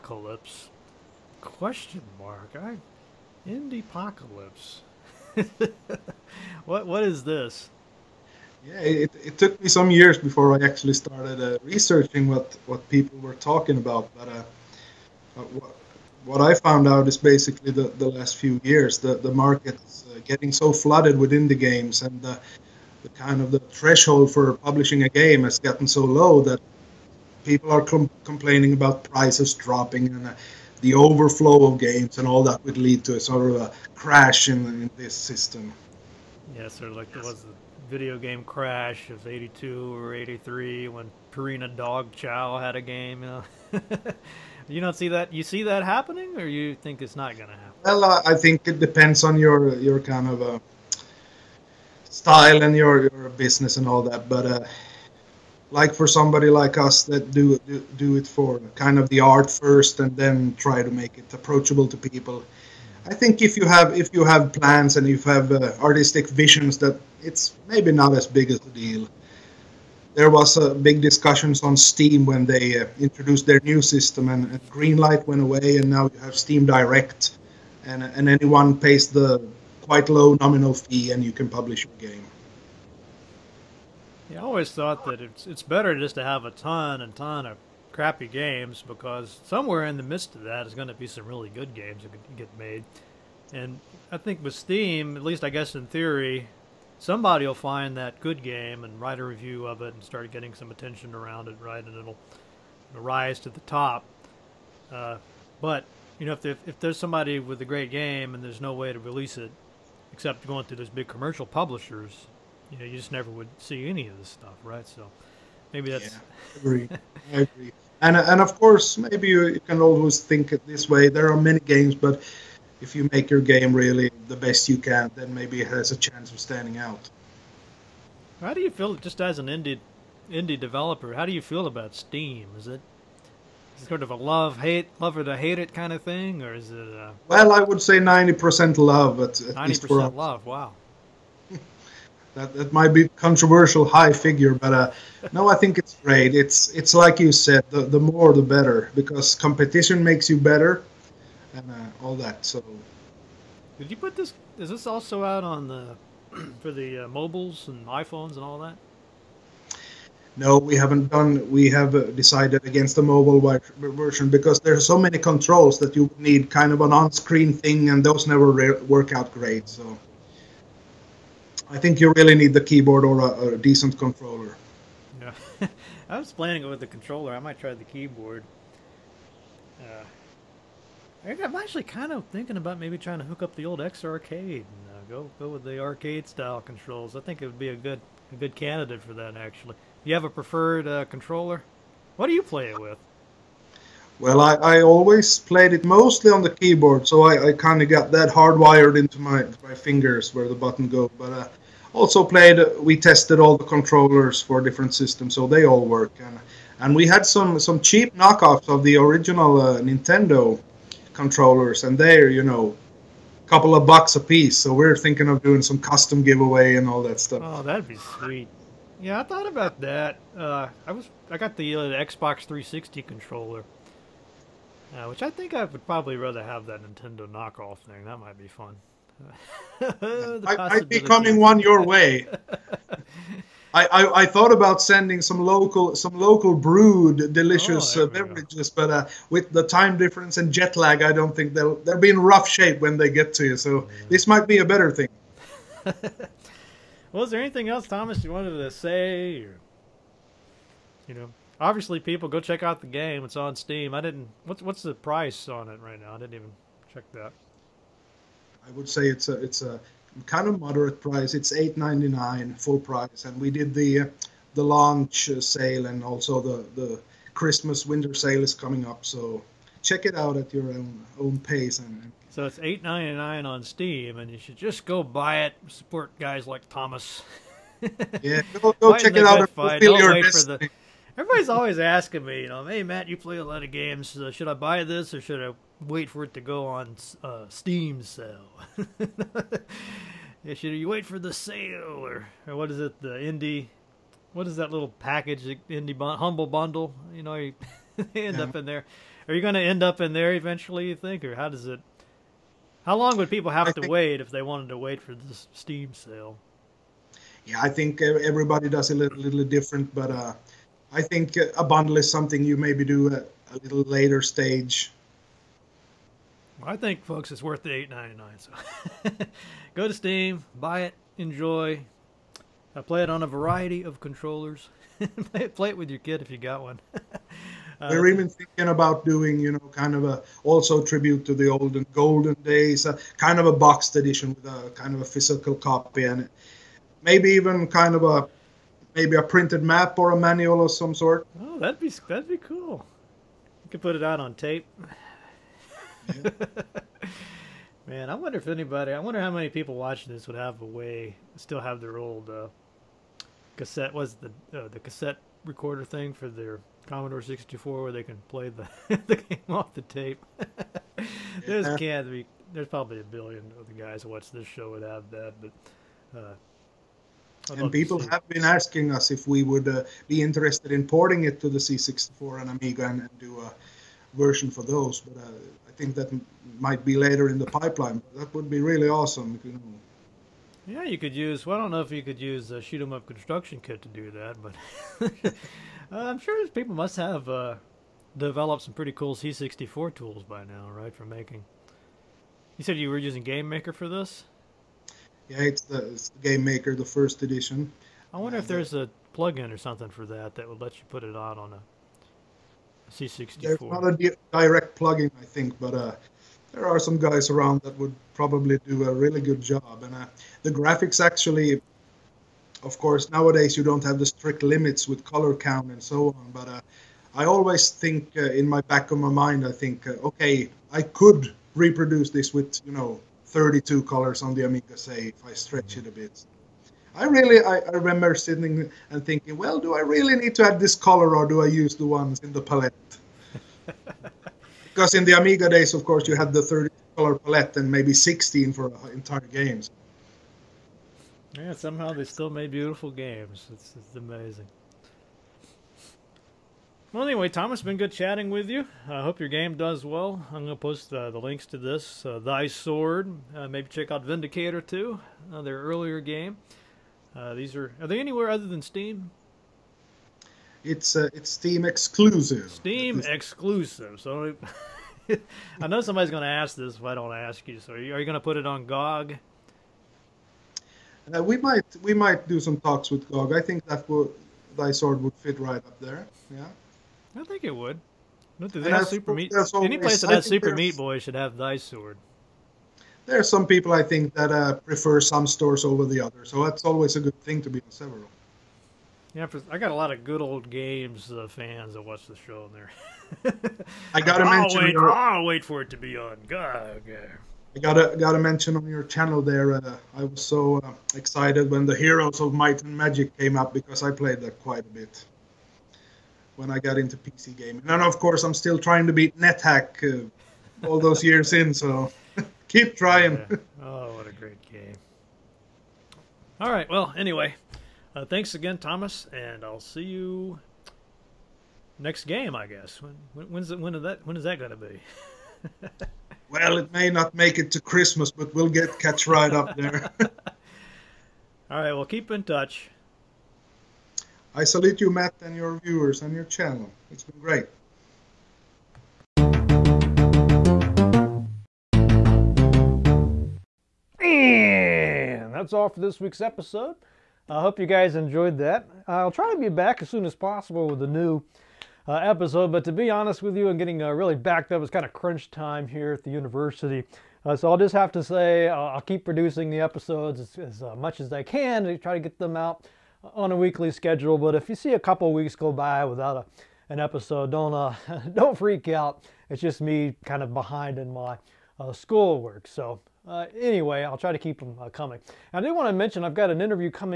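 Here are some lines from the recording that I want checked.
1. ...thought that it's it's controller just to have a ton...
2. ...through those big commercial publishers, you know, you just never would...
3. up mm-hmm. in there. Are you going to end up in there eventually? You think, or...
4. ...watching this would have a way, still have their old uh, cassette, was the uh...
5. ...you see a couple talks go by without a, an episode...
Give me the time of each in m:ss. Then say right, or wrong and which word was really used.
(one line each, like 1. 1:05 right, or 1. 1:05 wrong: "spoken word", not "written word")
1. 1:24 wrong: "better", not "controller"
2. 1:50 right
3. 4:58 right
4. 5:49 right
5. 9:24 wrong: "weeks", not "talks".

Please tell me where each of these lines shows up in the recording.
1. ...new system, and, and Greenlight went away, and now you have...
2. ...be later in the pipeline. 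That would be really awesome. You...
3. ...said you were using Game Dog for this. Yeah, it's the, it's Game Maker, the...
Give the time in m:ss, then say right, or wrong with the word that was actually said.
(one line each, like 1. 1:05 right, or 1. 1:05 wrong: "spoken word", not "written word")
1. 1:13 right
2. 6:16 right
3. 6:32 wrong: "Maker", not "Dog".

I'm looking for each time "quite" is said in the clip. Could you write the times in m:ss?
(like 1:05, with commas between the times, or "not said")
1:19, 8:24.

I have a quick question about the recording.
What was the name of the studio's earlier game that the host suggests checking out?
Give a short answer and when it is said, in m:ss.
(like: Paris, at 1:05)
Vindicator, at 7:34.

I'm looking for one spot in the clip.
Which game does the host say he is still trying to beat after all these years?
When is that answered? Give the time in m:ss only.
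8:29.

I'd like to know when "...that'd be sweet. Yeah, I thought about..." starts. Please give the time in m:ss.
3:37.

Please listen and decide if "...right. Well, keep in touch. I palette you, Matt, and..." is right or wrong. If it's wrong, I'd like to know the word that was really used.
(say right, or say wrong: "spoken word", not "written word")
wrong: "salute", not "palette".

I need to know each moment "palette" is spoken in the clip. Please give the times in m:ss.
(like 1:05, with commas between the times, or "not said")
7:12, 7:17.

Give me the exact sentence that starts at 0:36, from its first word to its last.
Yeah, sort of like there was video game crash of 82 or 83 when Purina Dog Chow had a game.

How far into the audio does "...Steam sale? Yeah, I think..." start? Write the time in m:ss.
5:05.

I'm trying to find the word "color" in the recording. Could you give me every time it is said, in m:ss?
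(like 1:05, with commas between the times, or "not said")
6:55, 7:03, 7:10, 7:16.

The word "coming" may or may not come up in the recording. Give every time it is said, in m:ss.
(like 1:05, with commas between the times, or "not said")
3:51, 4:28, 9:34.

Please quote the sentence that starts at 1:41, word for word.
And it'll, it'll rise to the top.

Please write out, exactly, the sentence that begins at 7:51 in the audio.
Uh, we might we might do some talks with GOG.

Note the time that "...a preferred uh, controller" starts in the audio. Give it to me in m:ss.
3:10.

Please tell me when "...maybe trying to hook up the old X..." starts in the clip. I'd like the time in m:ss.
3:02.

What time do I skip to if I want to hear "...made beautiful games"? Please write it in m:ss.
7:22.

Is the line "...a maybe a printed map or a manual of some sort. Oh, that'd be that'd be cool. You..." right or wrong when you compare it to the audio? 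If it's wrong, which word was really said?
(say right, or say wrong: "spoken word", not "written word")
right.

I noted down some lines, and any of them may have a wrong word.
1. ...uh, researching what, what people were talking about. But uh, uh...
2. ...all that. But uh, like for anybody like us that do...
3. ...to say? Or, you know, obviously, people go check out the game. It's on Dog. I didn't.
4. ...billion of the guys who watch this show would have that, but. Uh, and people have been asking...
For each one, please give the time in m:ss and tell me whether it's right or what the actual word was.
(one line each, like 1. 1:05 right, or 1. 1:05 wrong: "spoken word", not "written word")
1. 0:11 right
2. 0:53 wrong: "somebody", not "anybody"
3. 4:08 wrong: "Steam", not "Dog"
4. 6:03 right.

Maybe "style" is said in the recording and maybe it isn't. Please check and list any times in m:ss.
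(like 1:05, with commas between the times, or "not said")
0:52, 3:06.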